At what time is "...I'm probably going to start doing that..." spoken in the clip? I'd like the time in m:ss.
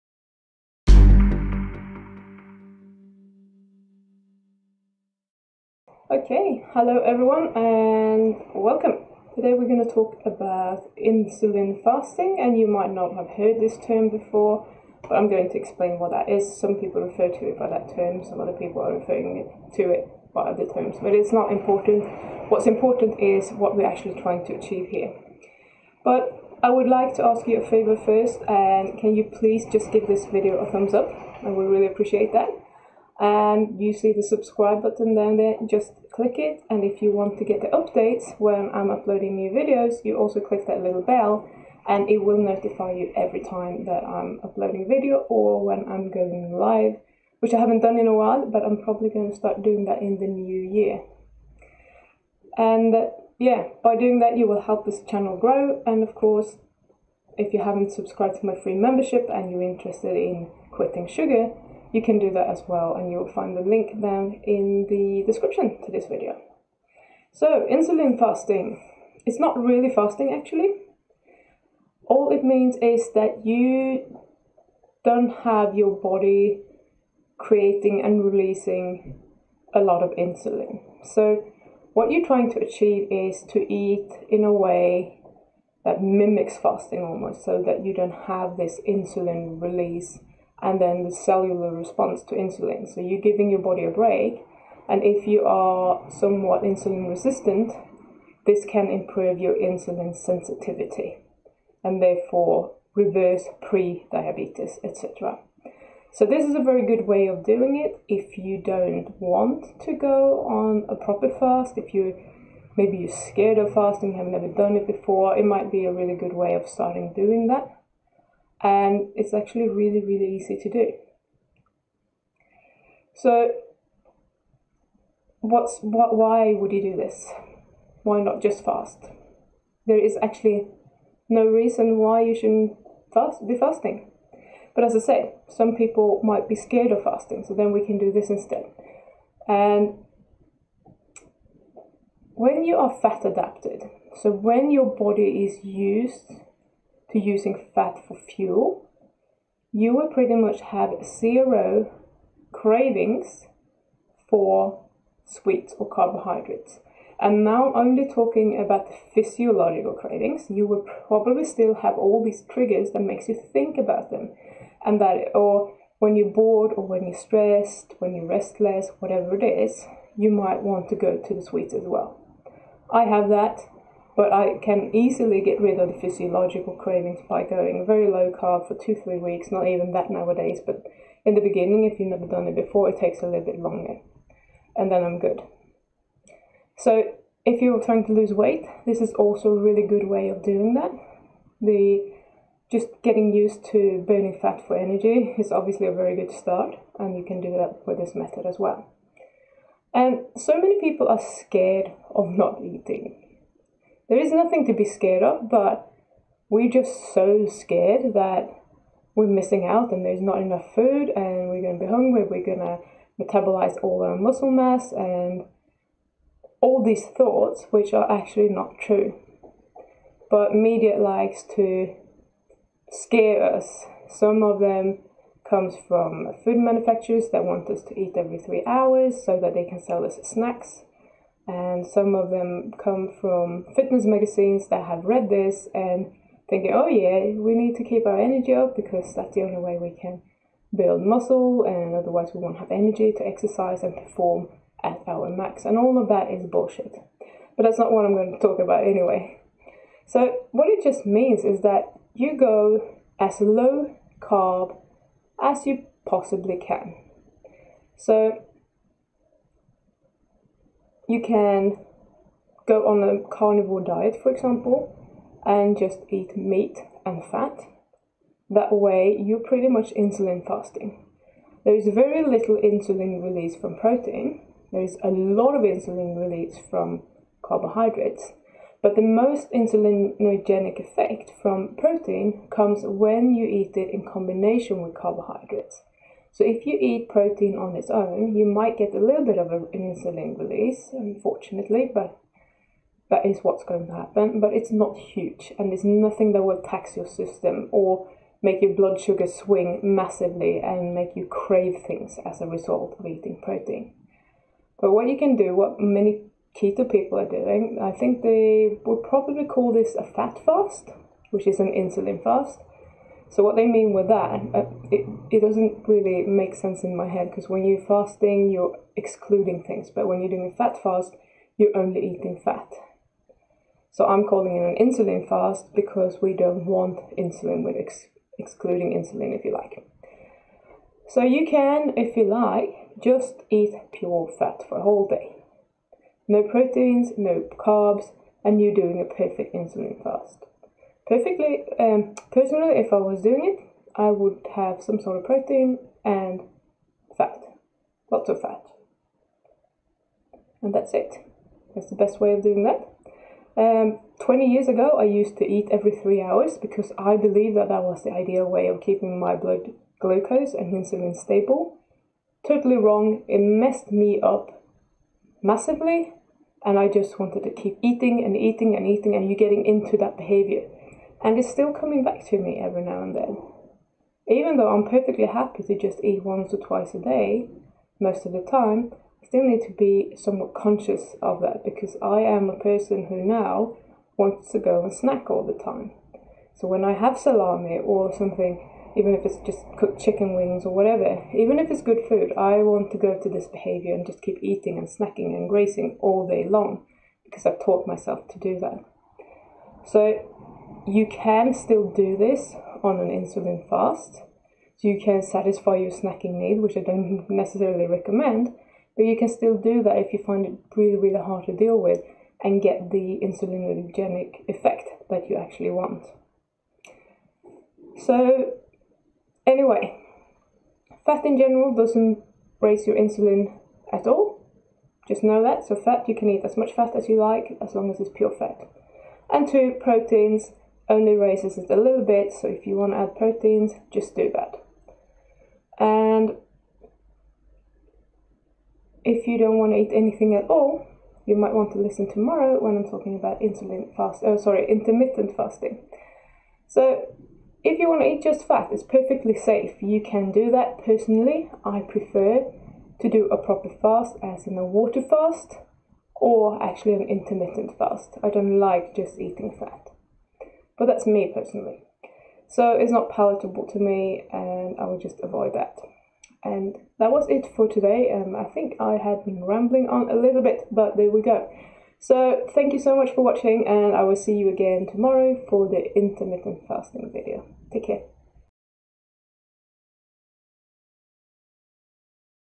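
0:48.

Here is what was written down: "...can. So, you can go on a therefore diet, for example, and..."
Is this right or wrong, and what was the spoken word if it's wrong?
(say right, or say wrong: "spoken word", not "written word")
wrong: "carnivore", not "therefore".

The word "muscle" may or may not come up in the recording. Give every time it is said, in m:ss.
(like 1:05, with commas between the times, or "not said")
3:34, 4:01.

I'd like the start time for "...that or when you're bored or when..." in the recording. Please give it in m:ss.
2:44.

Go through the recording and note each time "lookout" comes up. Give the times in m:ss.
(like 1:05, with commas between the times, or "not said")
not said.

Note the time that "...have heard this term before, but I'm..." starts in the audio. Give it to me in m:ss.
0:13.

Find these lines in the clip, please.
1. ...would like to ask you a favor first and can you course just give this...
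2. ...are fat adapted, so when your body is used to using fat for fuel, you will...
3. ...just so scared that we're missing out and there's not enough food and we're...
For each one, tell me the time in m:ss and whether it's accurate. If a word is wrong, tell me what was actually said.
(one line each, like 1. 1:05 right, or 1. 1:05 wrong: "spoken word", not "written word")
1. 0:26 wrong: "please", not "course"
2. 2:22 right
3. 3:26 right.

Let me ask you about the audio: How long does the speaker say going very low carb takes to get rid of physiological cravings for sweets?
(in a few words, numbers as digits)
two, three weeks.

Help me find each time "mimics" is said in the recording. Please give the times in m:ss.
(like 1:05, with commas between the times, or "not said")
1:26.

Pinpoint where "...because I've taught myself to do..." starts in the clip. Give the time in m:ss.
6:37.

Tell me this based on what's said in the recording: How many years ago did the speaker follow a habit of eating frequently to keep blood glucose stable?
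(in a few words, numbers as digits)
20 years.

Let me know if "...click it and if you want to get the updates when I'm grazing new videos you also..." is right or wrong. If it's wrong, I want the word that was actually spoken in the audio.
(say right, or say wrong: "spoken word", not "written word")
wrong: "uploading", not "grazing".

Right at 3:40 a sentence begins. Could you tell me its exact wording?
But media likes to scare us.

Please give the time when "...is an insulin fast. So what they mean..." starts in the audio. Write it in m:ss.
5:11.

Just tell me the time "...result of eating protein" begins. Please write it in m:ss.
5:02.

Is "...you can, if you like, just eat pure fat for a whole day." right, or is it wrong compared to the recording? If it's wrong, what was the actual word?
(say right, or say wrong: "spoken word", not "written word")
right.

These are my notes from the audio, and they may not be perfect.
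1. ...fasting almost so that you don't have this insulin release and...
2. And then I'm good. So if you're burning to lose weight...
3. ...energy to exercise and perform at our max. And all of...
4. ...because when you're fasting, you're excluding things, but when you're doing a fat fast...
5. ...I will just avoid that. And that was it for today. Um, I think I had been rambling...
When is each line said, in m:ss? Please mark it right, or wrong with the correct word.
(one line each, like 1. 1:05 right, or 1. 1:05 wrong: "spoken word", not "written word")
1. 1:26 right
2. 3:04 wrong: "trying", not "burning"
3. 4:02 right
4. 5:17 right
5. 7:44 right.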